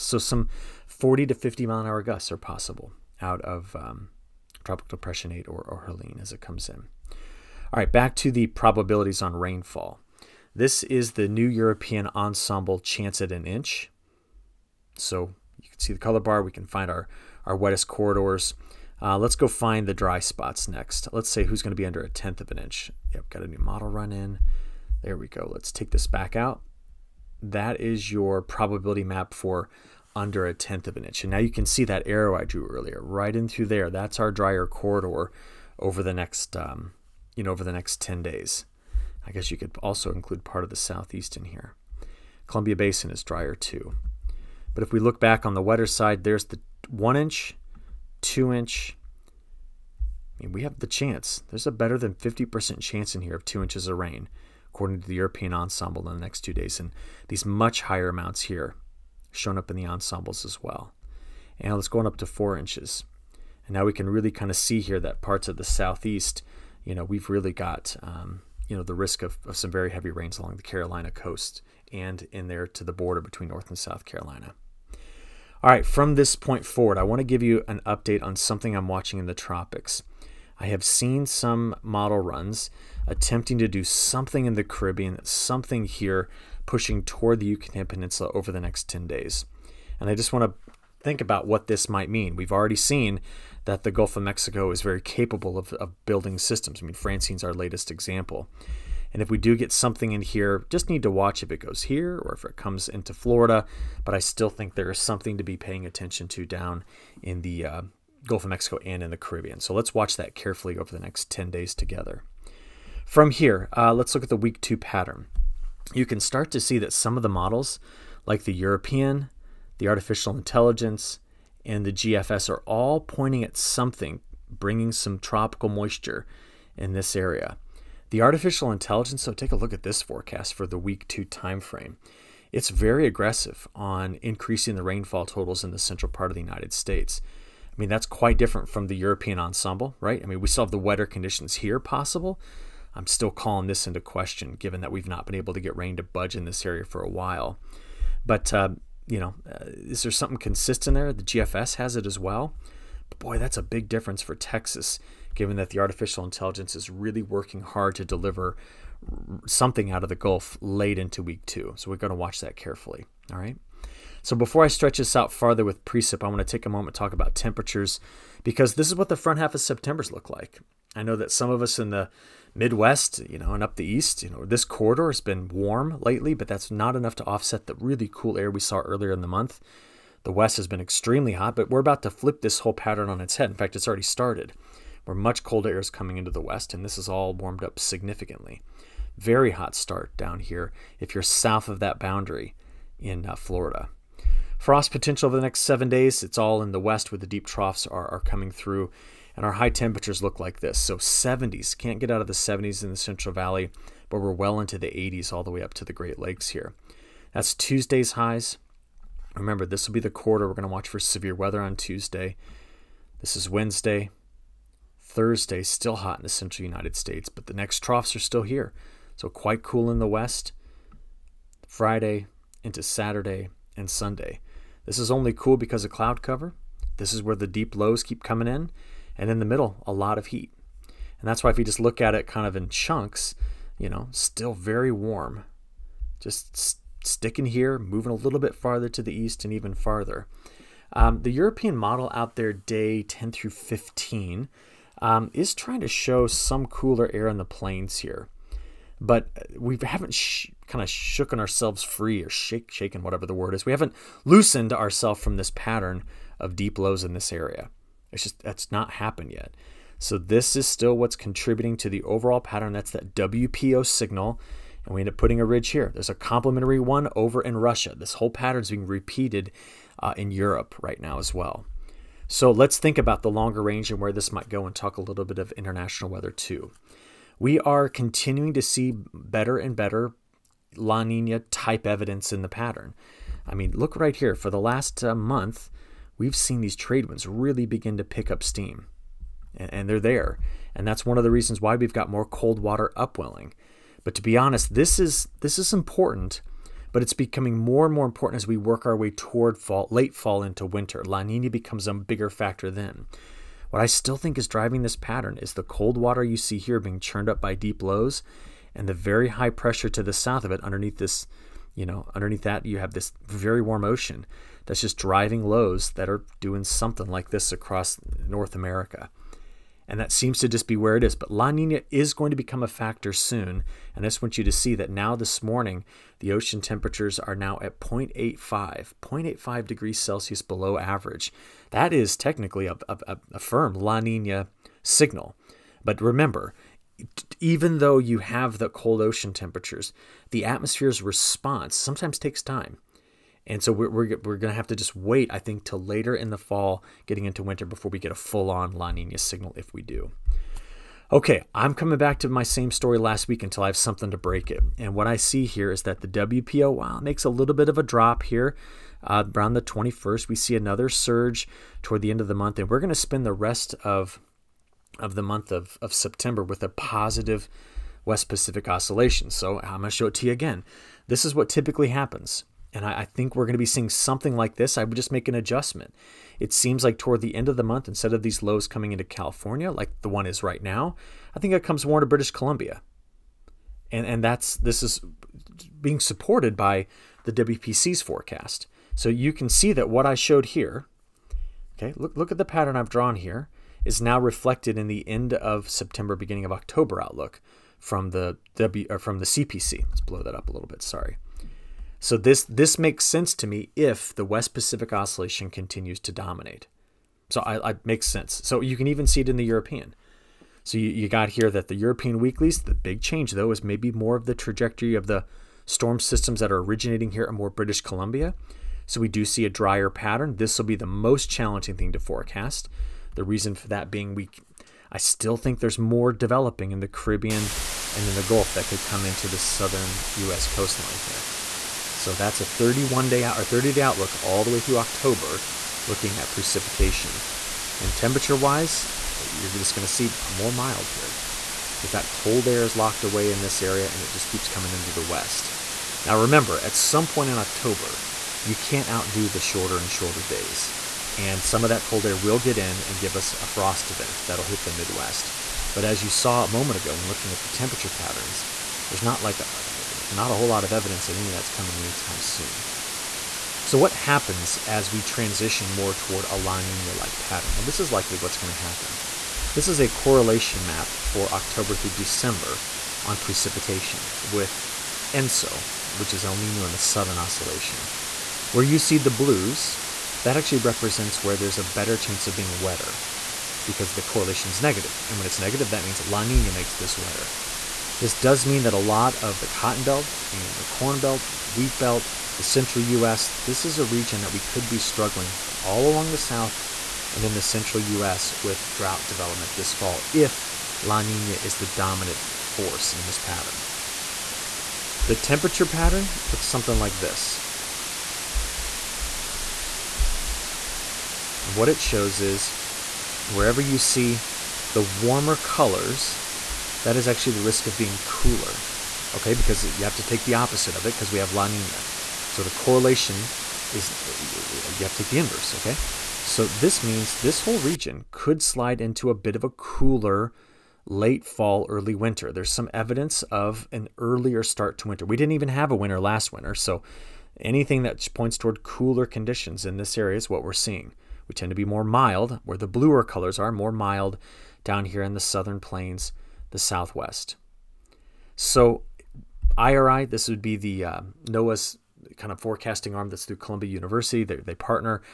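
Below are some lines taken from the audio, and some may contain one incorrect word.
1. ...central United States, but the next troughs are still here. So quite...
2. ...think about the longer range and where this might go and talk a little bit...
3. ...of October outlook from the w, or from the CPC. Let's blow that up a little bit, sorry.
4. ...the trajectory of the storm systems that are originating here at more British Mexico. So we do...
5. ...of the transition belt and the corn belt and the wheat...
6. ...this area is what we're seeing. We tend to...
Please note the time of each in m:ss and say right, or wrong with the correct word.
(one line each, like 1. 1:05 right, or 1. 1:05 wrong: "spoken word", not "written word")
1. 3:36 right
2. 4:32 right
3. 6:36 right
4. 6:54 wrong: "Columbia", not "Mexico"
5. 8:09 wrong: "cotton", not "transition"
6. 8:59 right.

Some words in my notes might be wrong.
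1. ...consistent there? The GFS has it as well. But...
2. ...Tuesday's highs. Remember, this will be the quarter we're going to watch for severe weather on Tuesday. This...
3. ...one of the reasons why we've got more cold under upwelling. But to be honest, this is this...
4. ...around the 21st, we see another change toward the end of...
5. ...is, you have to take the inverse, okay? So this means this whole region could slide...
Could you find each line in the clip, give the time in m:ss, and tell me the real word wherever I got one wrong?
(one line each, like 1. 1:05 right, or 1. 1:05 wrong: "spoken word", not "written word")
1. 2:30 right
2. 3:27 right
3. 4:51 wrong: "water", not "under"
4. 5:59 wrong: "surge", not "change"
5. 8:43 right.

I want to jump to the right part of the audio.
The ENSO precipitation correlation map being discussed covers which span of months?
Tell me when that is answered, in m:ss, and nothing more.
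7:51.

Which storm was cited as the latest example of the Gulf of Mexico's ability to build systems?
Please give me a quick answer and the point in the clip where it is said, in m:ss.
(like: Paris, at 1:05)
Francine, at 1:36.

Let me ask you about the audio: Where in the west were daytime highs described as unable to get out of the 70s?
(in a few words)
Central Valley.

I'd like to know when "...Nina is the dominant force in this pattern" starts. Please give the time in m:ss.
8:21.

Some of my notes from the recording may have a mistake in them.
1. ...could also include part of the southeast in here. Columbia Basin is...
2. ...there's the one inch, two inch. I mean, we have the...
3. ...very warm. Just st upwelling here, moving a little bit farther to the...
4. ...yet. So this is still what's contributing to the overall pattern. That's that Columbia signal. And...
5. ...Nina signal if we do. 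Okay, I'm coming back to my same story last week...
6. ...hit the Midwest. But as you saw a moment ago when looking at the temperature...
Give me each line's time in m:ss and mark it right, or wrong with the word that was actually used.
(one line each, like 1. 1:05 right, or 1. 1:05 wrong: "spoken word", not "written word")
1. 0:39 right
2. 0:46 right
3. 3:54 wrong: "sticking", not "upwelling"
4. 4:19 wrong: "WPO", not "Columbia"
5. 5:48 right
6. 7:34 right.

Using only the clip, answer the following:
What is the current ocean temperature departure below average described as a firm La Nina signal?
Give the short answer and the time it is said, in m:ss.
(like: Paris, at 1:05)
0.85 degrees Celsius, at 5:29.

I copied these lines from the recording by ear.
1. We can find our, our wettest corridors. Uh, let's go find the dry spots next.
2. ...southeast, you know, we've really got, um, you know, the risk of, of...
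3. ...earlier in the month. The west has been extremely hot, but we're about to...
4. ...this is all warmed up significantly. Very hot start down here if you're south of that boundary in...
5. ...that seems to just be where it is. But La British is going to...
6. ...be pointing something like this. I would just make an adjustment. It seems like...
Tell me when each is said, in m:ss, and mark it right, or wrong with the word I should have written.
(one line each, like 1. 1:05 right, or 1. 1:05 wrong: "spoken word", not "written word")
1. 0:16 right
2. 1:05 right
3. 2:58 right
4. 3:06 right
5. 5:19 wrong: "Nina", not "British"
6. 6:13 wrong: "seeing", not "pointing".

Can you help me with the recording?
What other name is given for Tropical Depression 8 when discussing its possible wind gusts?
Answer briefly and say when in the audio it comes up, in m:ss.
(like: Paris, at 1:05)
Helene, at 0:05.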